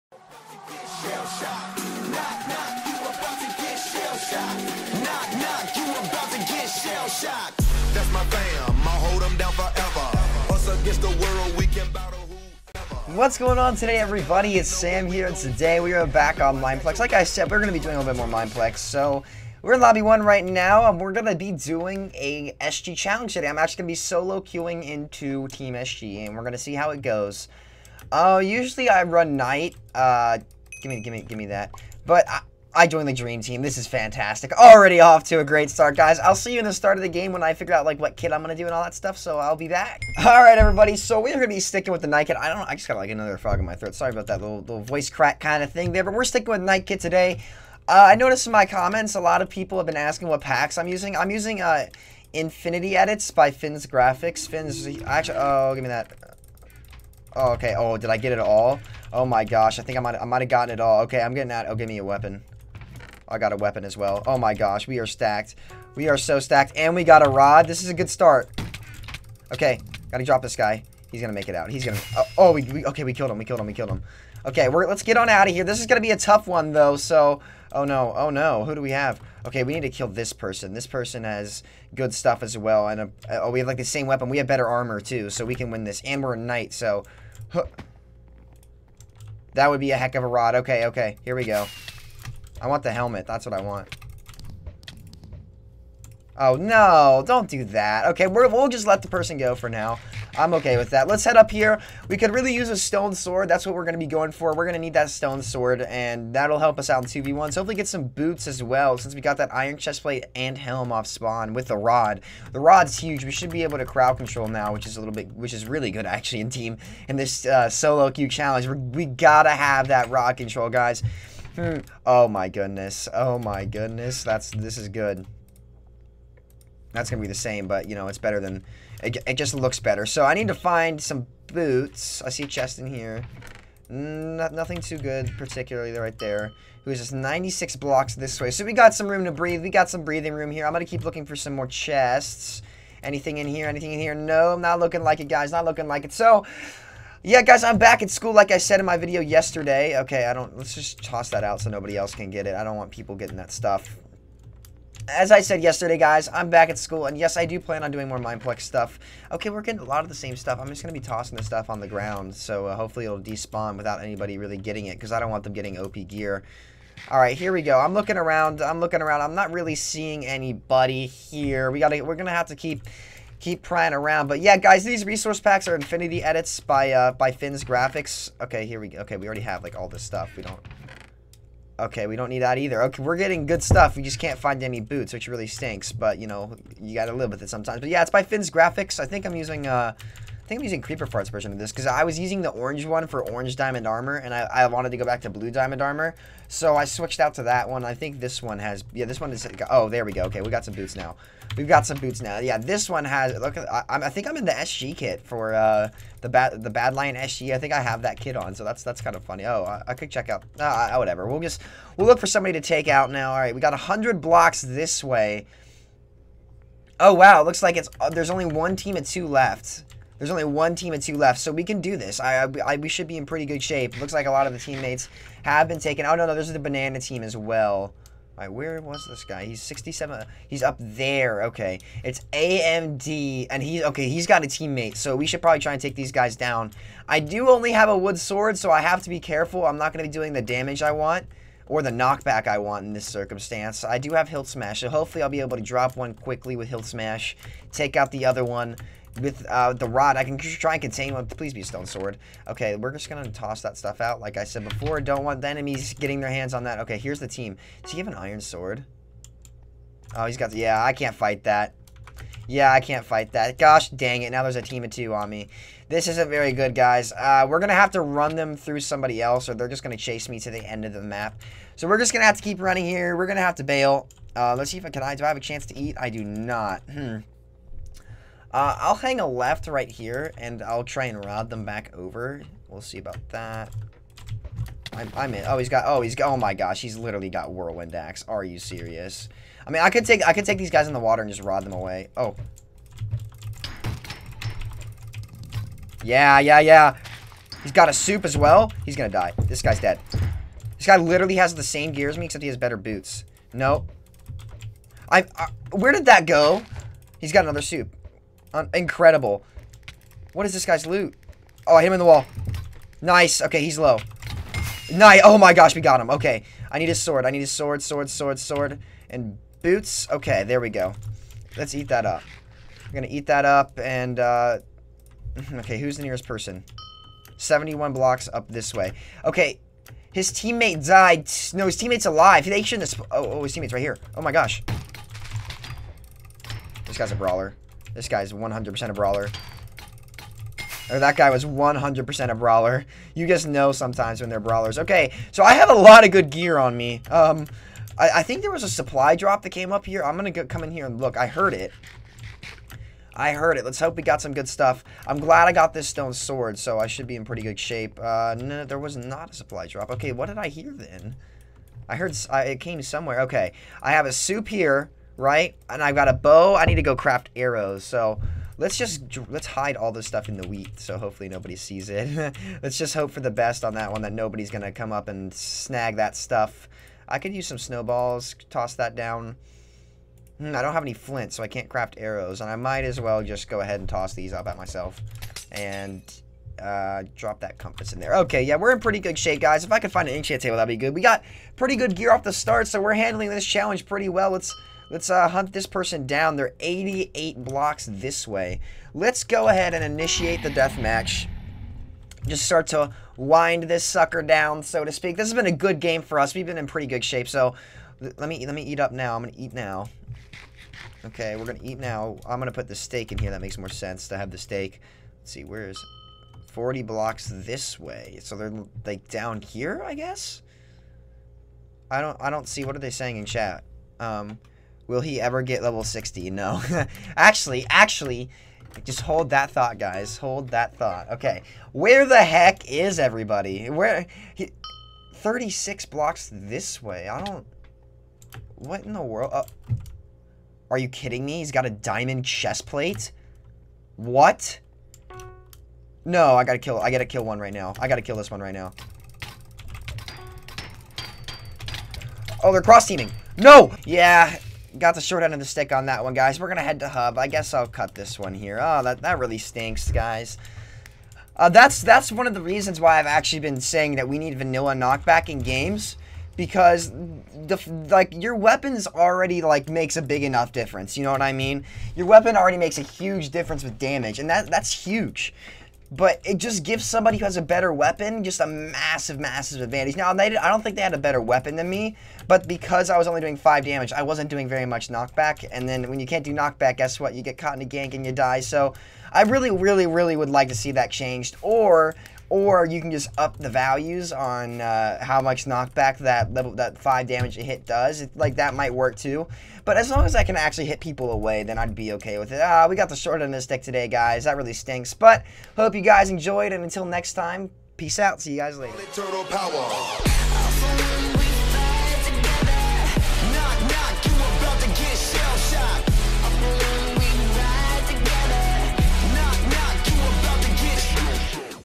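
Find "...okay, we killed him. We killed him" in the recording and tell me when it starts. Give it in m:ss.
1:12.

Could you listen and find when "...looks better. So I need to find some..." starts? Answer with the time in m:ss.
2:09.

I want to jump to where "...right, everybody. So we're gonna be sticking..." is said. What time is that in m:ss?
0:40.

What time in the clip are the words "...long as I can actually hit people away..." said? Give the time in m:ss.
8:19.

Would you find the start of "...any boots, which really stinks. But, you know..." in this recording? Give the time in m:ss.
3:04.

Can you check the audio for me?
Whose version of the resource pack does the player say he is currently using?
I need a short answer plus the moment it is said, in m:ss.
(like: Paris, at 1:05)
Creeper Farts, at 3:10.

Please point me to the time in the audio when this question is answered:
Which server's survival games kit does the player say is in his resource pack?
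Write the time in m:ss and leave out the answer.
3:26.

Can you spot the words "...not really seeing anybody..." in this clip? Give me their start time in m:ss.
2:49.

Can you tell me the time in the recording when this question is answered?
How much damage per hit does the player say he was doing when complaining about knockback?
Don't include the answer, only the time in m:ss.
8:03.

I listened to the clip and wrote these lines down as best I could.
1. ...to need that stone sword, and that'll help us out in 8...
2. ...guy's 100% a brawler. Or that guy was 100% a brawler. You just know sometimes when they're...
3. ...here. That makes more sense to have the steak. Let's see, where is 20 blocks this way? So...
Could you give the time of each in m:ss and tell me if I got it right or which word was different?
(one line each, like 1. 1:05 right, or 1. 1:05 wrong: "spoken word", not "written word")
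1. 1:44 wrong: "2", not "8"
2. 5:38 right
3. 6:53 wrong: "40", not "20".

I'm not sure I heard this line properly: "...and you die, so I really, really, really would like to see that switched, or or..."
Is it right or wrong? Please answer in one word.
wrong.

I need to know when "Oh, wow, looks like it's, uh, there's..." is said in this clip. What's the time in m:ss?
3:36.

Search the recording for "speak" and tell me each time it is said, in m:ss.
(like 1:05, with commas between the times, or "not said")
6:44.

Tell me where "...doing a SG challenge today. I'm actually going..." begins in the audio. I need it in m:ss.
0:21.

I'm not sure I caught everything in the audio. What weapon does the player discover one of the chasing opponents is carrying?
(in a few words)
whirlwind axe.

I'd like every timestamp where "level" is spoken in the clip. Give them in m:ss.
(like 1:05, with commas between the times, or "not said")
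7:05, 8:16.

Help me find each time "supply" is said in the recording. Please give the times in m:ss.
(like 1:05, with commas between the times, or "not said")
5:48, 5:59.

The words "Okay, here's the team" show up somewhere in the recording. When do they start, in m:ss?
4:16.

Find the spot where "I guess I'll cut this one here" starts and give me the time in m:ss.
7:37.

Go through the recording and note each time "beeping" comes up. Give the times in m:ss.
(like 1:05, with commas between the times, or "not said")
not said.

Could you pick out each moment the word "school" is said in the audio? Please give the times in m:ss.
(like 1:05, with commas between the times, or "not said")
2:28, 2:36.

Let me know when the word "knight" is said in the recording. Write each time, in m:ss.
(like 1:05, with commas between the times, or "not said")
0:29, 0:42, 0:46, 1:26.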